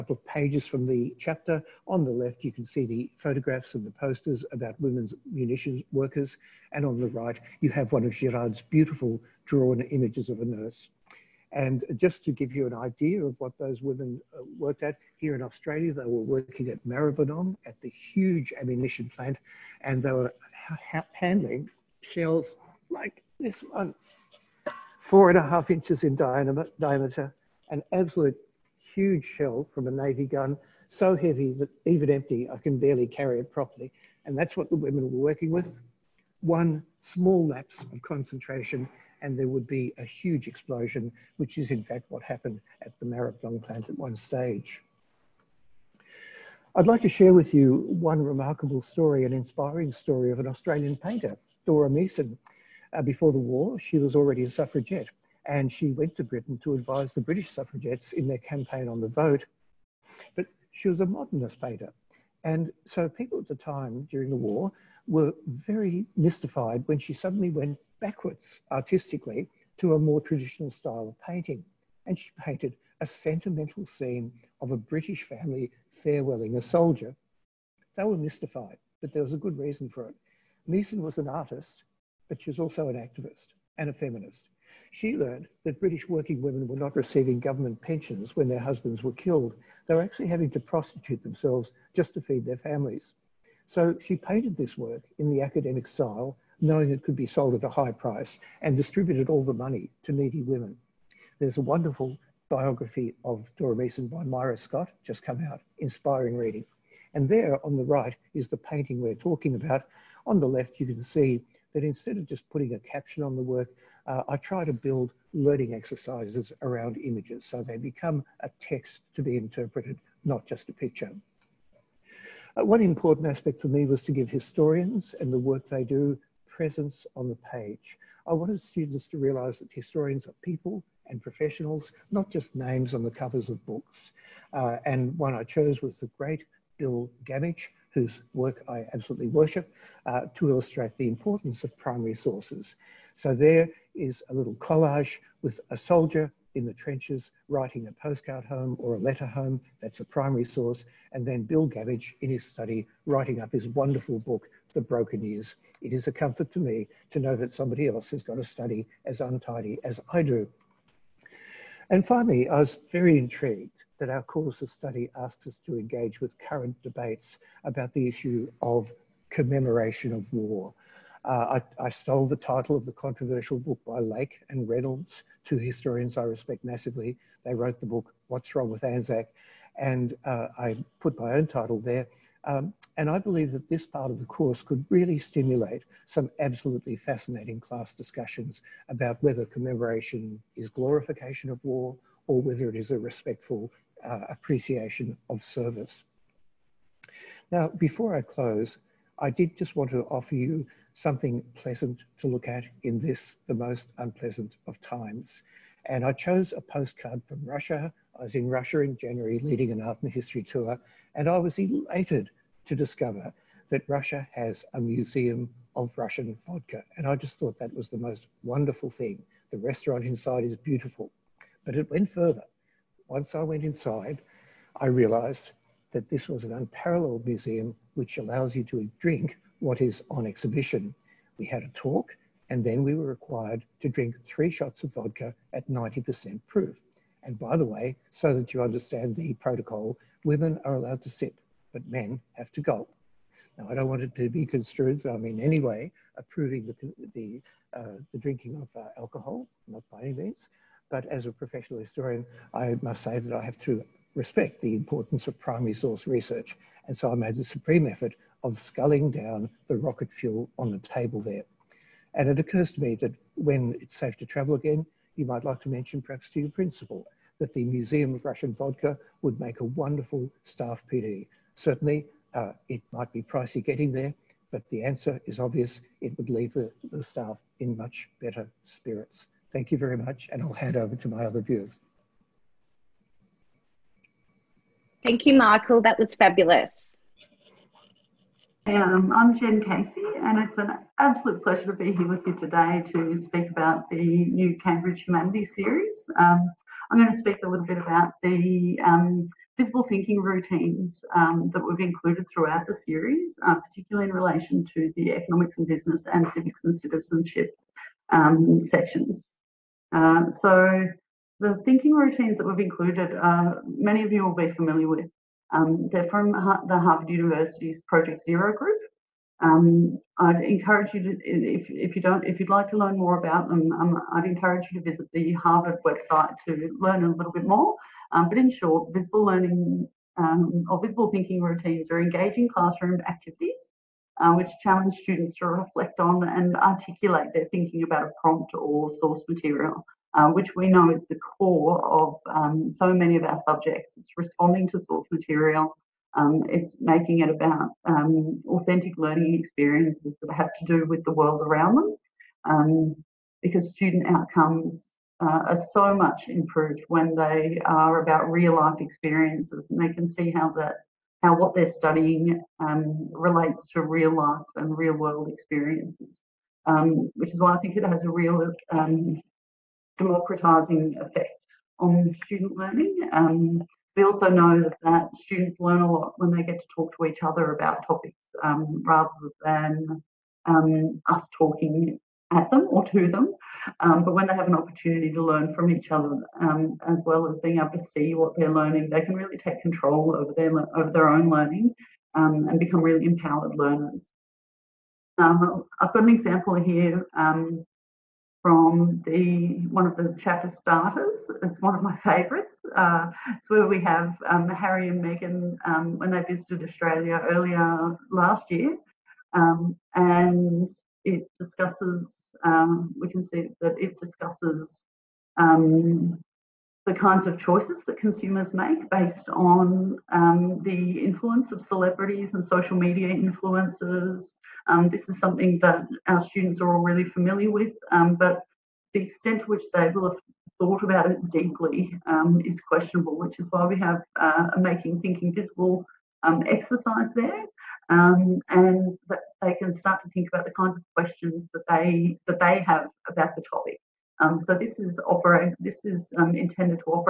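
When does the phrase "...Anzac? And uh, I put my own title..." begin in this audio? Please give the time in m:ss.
2:58.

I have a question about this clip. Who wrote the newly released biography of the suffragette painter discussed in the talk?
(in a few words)
Myra Scott.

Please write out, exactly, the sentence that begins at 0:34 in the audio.
And that's what the women were working with.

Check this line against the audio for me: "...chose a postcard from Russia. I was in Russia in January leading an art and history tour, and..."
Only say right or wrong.
right.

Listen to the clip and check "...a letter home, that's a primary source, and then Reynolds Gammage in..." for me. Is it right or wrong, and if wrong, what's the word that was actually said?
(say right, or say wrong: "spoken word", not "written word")
wrong: "Bill", not "Reynolds".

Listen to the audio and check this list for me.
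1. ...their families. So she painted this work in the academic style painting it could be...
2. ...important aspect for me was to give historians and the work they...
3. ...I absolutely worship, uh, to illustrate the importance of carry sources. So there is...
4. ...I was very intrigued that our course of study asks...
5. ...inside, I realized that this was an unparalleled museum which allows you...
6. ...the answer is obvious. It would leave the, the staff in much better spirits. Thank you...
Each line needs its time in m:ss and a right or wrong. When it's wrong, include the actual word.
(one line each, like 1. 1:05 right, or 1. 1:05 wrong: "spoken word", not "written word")
1. 1:32 wrong: "knowing", not "painting"
2. 2:02 right
3. 2:18 wrong: "primary", not "carry"
4. 2:42 right
5. 3:43 right
6. 4:34 right.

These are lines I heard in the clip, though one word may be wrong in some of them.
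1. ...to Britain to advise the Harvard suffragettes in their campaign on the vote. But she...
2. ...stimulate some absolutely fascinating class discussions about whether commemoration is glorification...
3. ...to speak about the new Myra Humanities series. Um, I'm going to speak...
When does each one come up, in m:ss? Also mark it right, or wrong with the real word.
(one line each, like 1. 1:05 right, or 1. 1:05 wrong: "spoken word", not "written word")
1. 0:56 wrong: "British", not "Harvard"
2. 3:05 right
3. 4:52 wrong: "Cambridge", not "Myra".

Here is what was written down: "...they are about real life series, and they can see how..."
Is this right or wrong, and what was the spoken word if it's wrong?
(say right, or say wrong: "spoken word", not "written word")
wrong: "experiences", not "series".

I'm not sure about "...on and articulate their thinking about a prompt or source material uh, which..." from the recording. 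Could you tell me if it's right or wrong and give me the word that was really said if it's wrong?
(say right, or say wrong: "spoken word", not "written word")
right.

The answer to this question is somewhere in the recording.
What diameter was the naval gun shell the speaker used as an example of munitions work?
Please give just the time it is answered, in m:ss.
0:25.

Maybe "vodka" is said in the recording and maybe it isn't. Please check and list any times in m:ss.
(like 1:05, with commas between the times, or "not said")
3:36, 3:54, 4:28.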